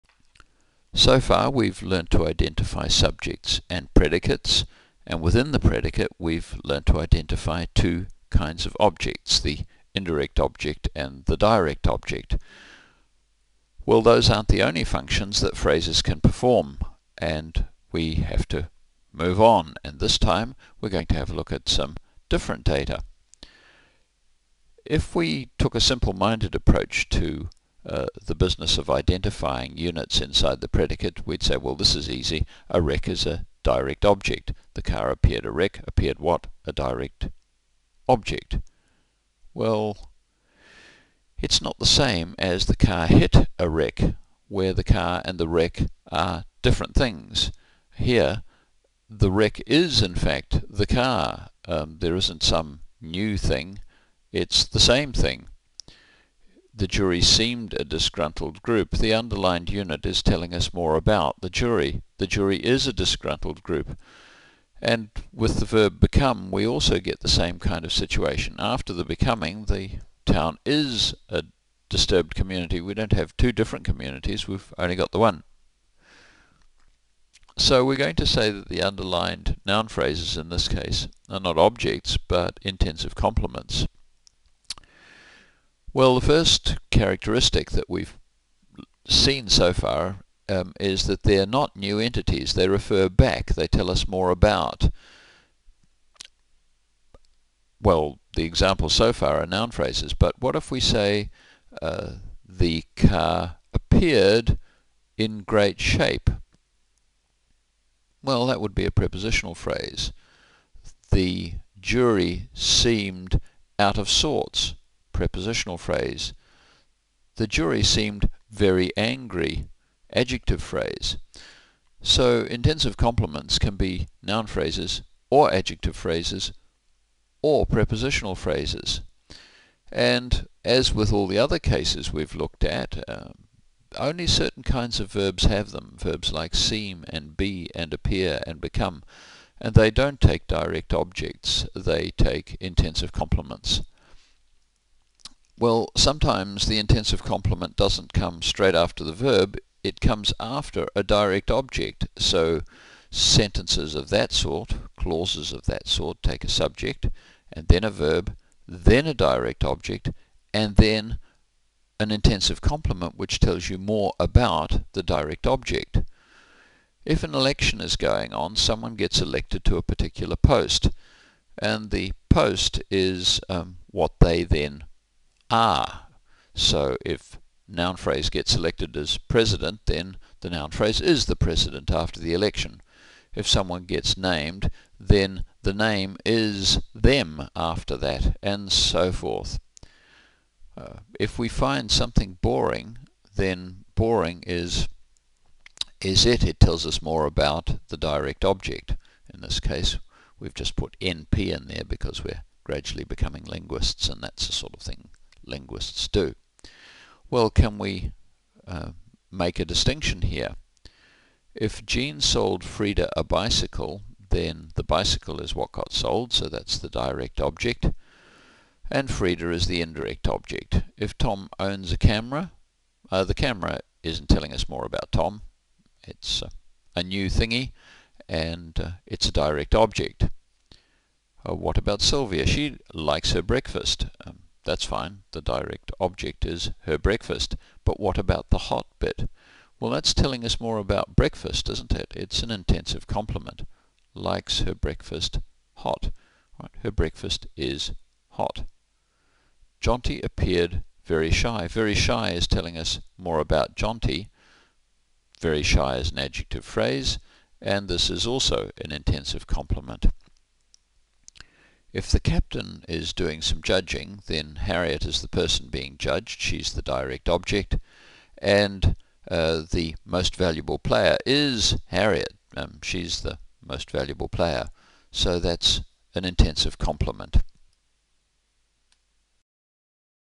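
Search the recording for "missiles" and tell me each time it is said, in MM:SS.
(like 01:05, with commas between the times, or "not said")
not said.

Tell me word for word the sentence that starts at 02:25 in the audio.
Well, sometimes the intensive complement doesn't come straight after the verb, it comes after a direct object.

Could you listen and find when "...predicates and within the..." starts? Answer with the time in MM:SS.
00:03.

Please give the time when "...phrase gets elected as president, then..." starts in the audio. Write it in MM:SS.
02:57.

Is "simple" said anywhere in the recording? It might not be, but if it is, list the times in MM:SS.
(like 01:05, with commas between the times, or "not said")
00:25.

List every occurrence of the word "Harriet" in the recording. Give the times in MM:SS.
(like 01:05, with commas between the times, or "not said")
04:24, 04:31.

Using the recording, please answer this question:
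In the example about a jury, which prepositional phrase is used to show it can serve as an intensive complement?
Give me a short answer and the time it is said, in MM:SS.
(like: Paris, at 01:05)
out of sorts, at 01:53.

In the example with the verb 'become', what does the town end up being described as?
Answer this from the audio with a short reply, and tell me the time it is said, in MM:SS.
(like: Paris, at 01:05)
a disturbed community, at 01:11.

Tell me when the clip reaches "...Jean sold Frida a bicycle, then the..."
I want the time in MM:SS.
03:31.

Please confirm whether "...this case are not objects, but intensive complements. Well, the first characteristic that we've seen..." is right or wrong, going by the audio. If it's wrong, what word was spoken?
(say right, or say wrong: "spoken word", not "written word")
right.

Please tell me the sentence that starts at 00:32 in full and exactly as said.
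A wreck is a direct object.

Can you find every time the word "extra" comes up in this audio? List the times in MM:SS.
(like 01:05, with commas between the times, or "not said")
not said.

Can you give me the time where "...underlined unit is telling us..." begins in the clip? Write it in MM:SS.
00:59.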